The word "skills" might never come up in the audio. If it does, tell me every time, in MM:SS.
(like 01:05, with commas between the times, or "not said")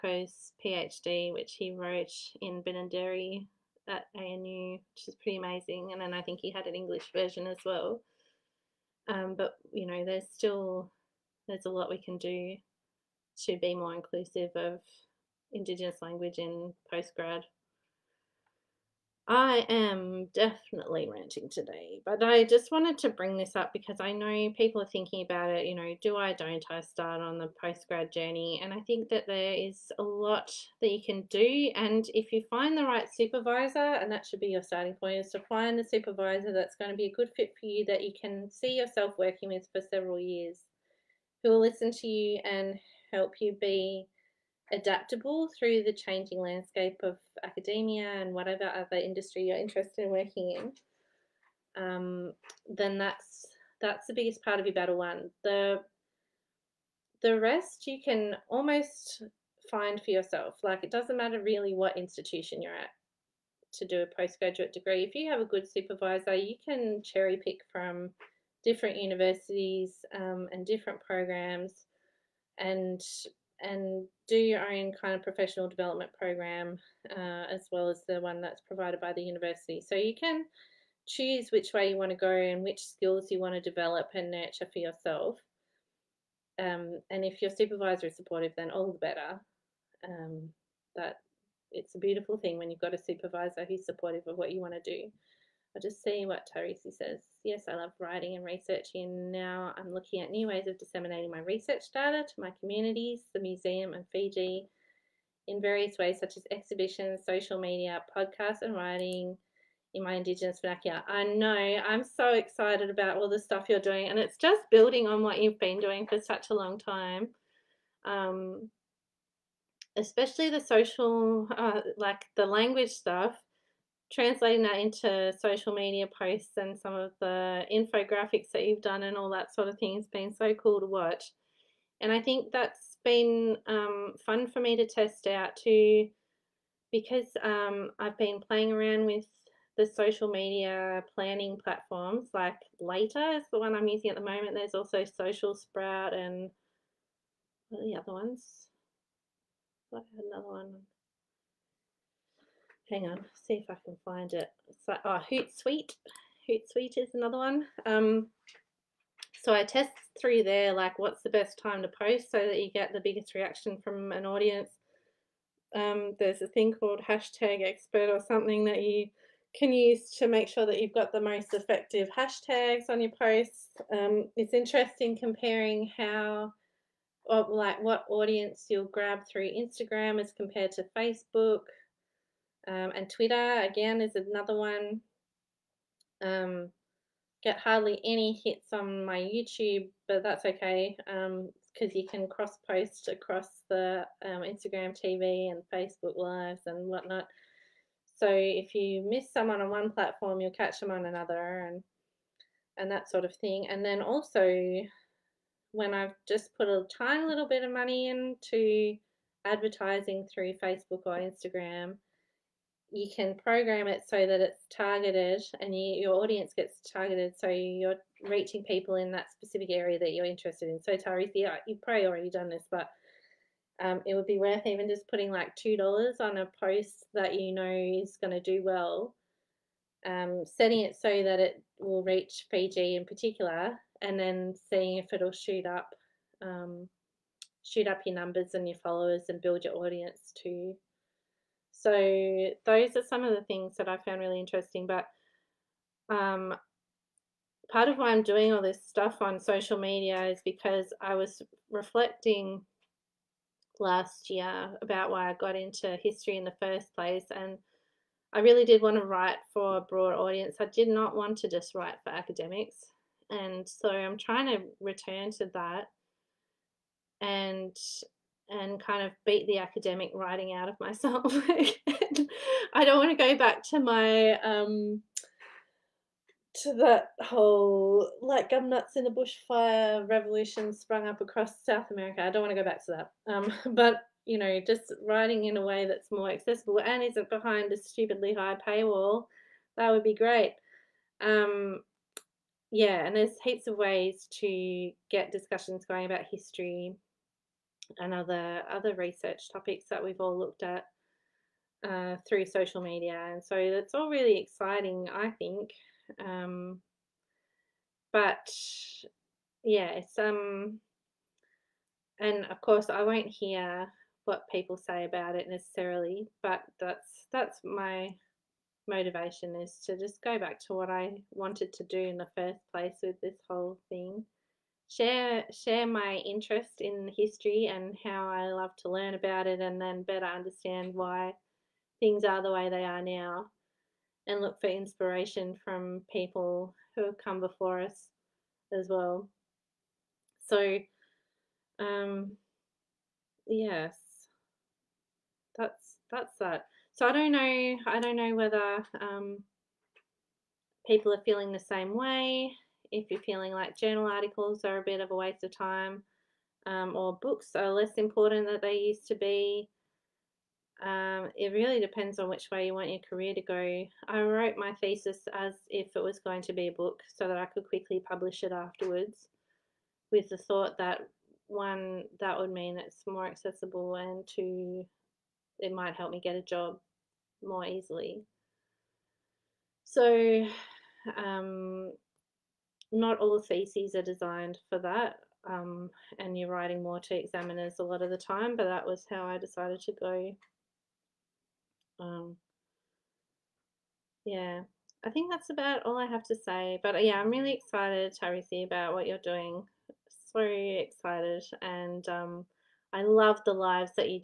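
01:22.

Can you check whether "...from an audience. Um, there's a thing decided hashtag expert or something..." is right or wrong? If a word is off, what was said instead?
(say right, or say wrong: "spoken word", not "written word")
wrong: "called", not "decided".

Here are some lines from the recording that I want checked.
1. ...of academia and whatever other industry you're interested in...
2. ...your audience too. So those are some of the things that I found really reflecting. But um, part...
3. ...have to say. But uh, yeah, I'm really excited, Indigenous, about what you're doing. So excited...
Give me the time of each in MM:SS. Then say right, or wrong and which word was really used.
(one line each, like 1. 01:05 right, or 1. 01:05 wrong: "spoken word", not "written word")
1. 00:47 right
2. 03:59 wrong: "interesting", not "reflecting"
3. 06:36 wrong: "Tarisi", not "Indigenous".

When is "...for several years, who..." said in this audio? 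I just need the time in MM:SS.
00:39.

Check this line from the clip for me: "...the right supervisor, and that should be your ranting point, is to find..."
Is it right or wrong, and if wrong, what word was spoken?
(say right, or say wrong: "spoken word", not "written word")
wrong: "starting", not "ranting".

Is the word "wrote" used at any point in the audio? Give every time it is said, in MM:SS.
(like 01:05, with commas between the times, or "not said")
00:01, 06:04.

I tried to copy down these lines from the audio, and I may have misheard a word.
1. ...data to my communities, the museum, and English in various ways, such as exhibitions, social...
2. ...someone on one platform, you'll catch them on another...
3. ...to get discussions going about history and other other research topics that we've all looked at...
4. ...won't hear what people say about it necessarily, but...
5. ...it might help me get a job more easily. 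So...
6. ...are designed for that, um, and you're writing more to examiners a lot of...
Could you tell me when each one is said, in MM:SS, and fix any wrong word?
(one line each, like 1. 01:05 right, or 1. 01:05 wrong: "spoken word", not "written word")
1. 01:41 wrong: "Fiji", not "English"
2. 03:19 right
3. 04:54 right
4. 05:13 right
5. 06:15 right
6. 06:23 right.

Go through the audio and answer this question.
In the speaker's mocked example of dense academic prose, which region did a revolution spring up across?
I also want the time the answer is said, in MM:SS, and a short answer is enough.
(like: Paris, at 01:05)
South America, at 04:41.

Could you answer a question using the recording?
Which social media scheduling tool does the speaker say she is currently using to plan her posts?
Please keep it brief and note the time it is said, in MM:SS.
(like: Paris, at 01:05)
Later, at 02:22.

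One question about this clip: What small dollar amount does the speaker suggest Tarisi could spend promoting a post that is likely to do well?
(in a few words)
$2.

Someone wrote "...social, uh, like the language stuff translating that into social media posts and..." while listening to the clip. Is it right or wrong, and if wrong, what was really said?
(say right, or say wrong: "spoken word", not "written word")
right.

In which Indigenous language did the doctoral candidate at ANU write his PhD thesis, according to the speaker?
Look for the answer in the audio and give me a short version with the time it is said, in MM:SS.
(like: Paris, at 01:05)
Binandere, at 00:02.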